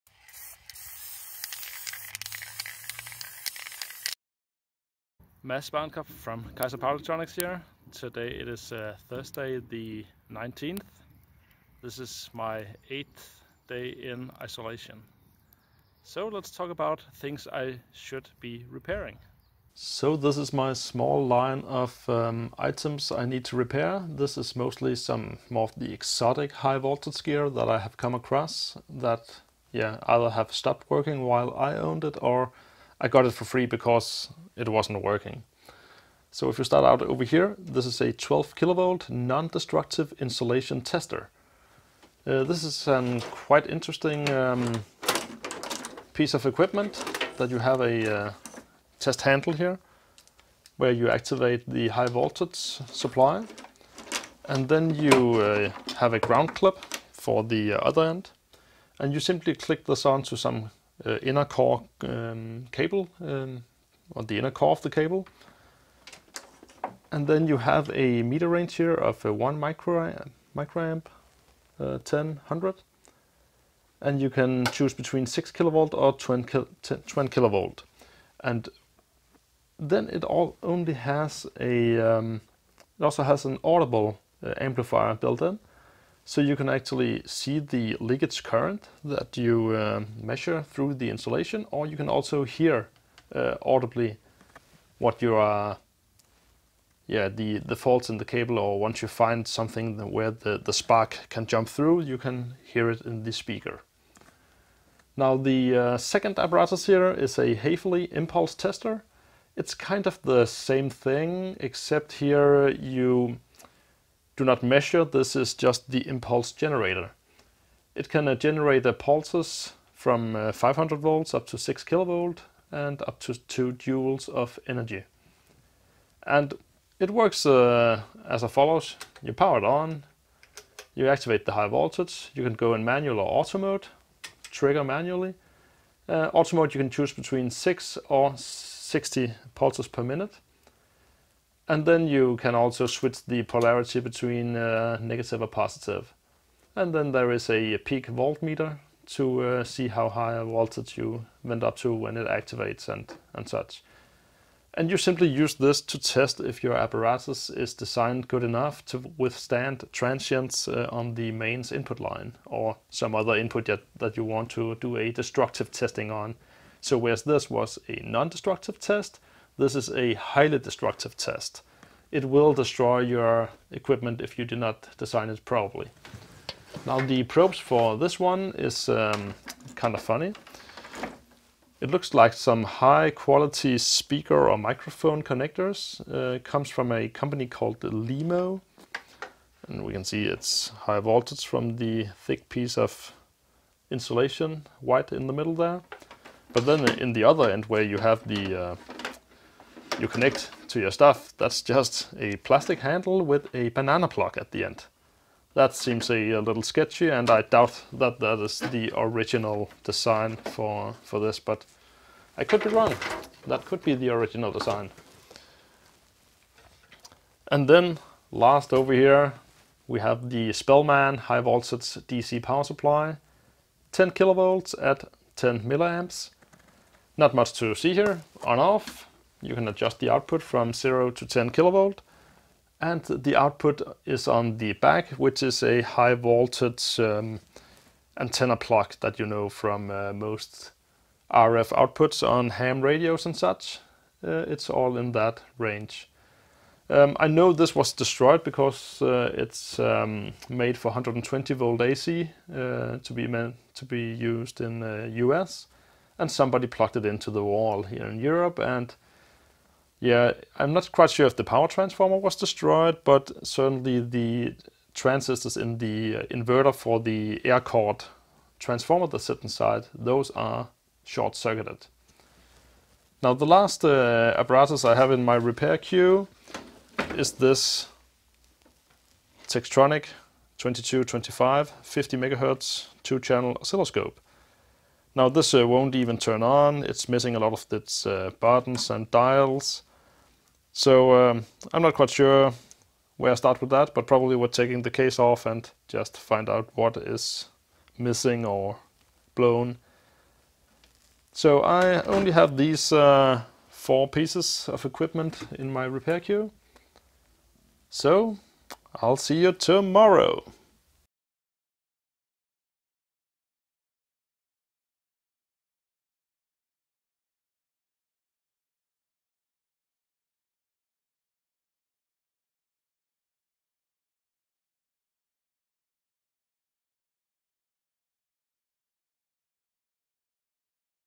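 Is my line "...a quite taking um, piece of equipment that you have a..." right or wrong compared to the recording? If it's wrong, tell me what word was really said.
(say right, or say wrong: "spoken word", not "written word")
wrong: "interesting", not "taking".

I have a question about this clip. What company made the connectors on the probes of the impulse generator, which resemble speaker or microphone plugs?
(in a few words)
LEMO.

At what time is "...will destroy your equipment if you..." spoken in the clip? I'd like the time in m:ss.
2:52.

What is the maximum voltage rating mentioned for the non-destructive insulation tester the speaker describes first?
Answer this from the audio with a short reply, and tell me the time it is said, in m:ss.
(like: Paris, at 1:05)
12 kilovolt, at 0:38.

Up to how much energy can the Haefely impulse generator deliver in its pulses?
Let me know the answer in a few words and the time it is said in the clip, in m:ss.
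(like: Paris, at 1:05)
2 joules, at 2:03.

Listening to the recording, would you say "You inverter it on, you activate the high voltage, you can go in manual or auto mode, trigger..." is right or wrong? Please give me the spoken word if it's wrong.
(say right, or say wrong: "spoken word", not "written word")
wrong: "power", not "inverter".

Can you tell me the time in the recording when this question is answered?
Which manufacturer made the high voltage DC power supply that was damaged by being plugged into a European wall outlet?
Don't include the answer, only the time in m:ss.
3:40.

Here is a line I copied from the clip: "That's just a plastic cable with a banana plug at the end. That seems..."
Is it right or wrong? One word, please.
wrong.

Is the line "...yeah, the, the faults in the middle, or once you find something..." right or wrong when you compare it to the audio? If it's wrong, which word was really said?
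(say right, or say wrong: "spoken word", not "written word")
wrong: "cable", not "middle".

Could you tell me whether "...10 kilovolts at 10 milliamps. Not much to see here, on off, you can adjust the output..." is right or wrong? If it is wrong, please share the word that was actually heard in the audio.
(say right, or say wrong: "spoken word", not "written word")
right.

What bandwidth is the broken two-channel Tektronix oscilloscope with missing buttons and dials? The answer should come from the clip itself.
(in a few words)
50 megahertz.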